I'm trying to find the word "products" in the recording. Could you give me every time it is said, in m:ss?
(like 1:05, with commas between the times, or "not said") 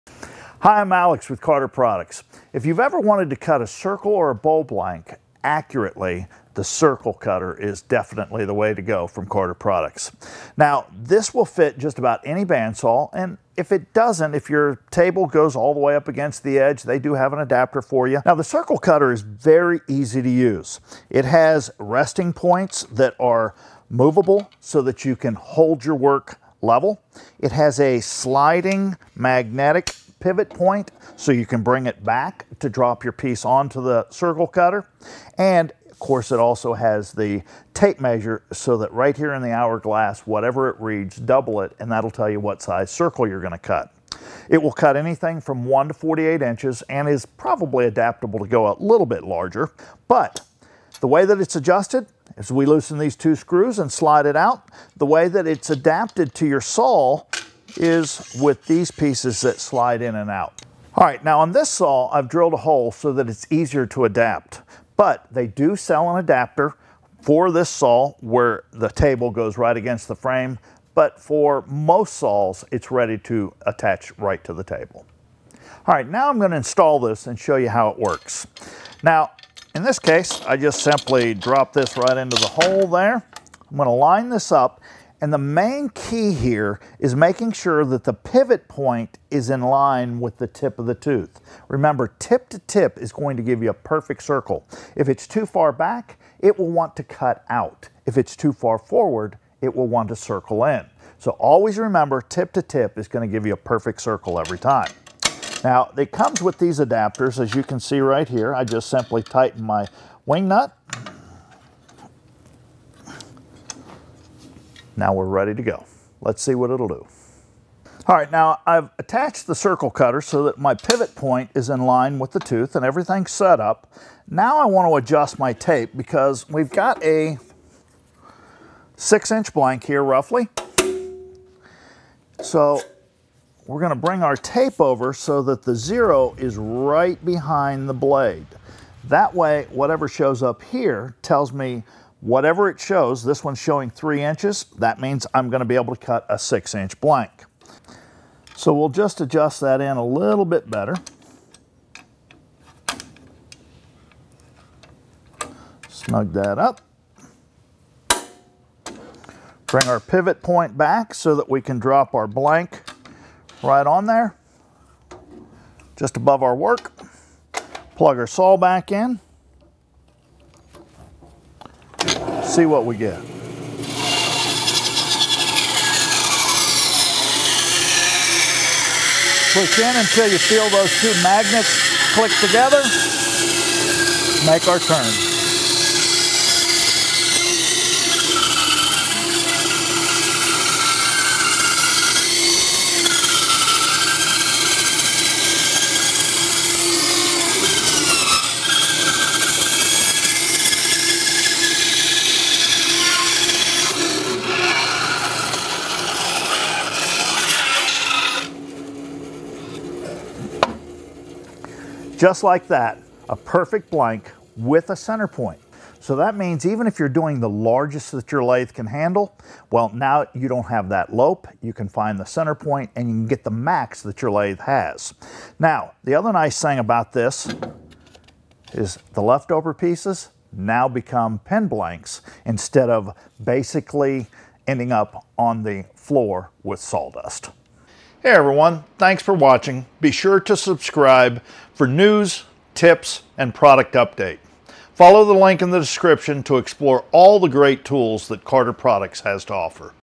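0:01, 0:09, 4:03, 4:08.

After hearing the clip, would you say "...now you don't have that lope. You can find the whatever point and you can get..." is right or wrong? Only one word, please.
wrong.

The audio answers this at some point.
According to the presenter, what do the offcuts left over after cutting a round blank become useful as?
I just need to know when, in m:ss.
3:51.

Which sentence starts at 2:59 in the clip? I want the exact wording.
Push in until you feel those two magnets click together.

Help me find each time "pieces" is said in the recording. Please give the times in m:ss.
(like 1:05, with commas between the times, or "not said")
0:33, 0:58, 3:49.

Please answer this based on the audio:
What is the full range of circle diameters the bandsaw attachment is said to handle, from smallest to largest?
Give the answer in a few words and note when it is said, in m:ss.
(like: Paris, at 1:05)
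1 to 48 inches, at 0:45.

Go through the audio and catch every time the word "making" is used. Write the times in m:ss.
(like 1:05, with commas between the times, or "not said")
1:27.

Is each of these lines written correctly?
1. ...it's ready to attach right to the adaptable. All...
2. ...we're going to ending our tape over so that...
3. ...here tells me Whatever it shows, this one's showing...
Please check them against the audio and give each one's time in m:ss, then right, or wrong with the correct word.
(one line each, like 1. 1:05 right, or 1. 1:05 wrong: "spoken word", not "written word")
1. 1:12 wrong: "table", not "adaptable"
2. 2:13 wrong: "bring", not "ending"
3. 2:20 right.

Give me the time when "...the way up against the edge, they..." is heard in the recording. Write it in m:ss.
0:15.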